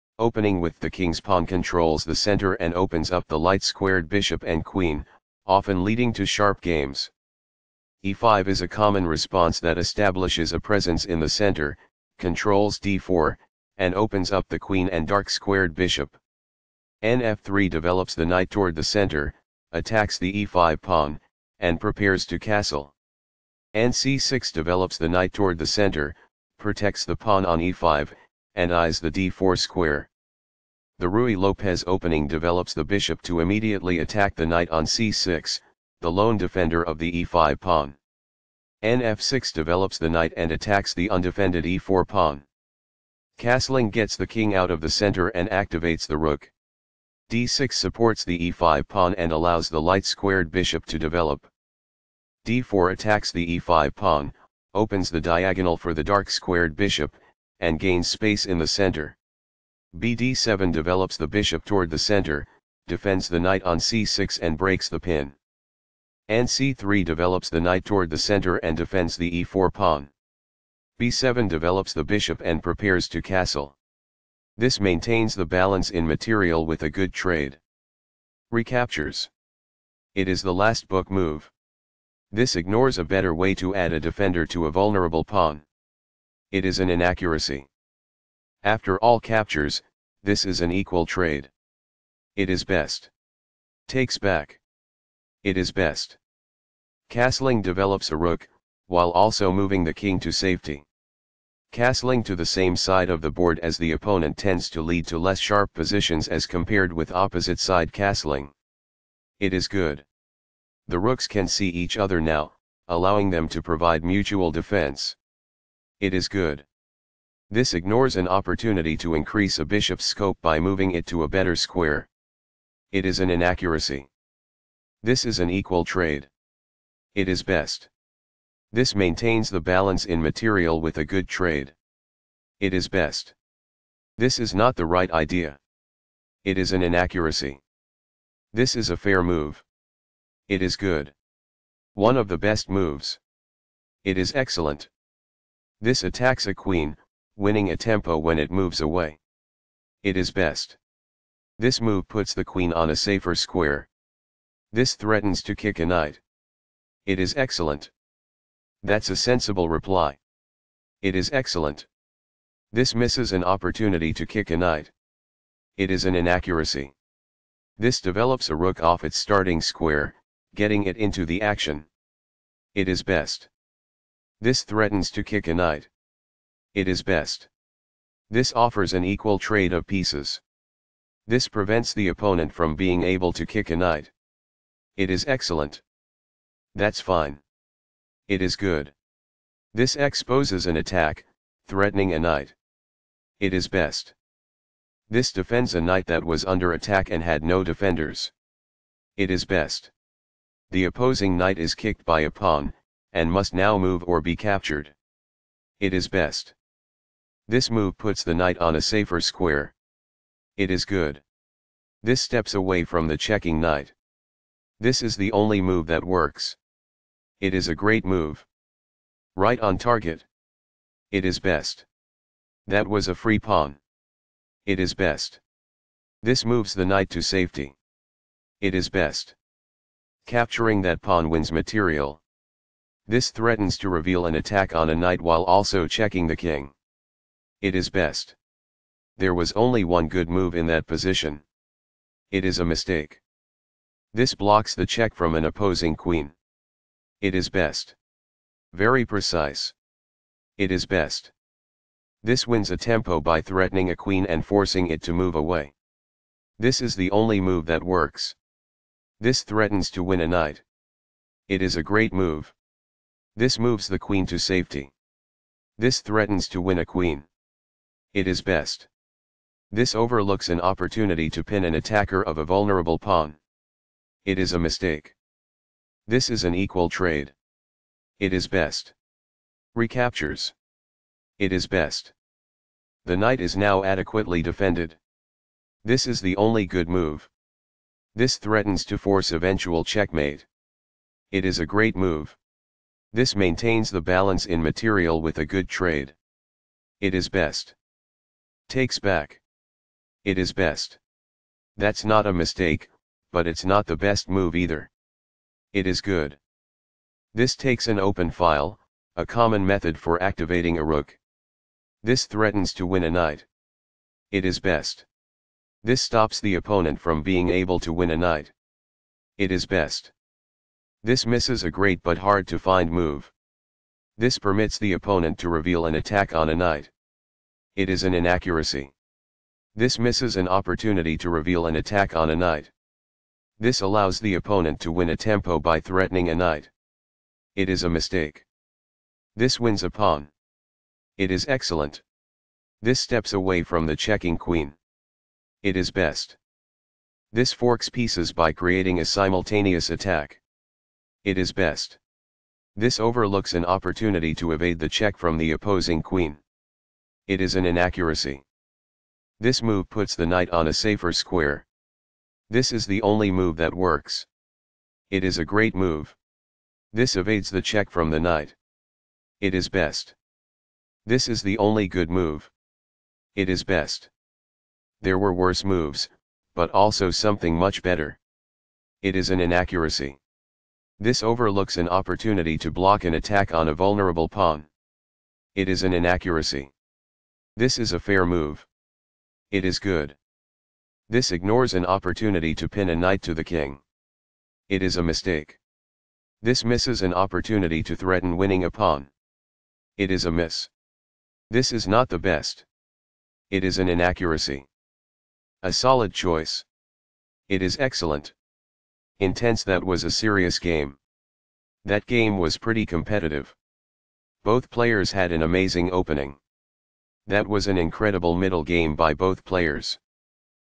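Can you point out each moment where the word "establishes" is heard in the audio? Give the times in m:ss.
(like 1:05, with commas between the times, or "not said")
0:09.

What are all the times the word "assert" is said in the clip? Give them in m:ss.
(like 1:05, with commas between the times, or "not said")
not said.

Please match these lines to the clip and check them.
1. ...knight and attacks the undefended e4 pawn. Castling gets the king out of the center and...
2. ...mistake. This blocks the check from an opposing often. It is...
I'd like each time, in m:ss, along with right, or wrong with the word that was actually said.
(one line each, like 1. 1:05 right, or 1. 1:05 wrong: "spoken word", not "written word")
1. 0:40 right
2. 4:02 wrong: "queen", not "often".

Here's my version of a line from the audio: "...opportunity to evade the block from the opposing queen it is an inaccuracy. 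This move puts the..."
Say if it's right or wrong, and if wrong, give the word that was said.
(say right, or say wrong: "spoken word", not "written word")
wrong: "check", not "block".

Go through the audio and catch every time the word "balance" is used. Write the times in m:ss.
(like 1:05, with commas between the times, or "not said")
1:15, 2:09, 4:54.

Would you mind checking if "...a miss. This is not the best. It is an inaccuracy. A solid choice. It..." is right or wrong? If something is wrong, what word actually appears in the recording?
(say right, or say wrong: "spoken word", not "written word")
right.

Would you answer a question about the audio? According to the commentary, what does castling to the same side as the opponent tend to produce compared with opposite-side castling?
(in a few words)
less sharp positions.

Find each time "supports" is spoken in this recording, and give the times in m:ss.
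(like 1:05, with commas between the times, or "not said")
0:47.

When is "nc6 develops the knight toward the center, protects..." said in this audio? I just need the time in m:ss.
0:23.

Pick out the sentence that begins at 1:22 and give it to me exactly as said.
This ignores a better way to add a defender to a vulnerable pawn.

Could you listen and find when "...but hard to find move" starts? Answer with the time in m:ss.
5:22.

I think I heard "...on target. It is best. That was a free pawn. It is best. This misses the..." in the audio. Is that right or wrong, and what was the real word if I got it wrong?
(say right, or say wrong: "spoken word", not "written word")
wrong: "moves", not "misses".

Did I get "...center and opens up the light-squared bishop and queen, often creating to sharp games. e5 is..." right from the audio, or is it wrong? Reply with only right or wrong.
wrong.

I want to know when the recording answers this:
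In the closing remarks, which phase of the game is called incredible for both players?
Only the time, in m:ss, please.
6:58.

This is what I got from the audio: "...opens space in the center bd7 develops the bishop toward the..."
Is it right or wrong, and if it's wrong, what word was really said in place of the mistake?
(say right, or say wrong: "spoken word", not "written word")
wrong: "gains", not "opens".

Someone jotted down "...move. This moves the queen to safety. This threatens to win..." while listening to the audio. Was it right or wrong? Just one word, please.
right.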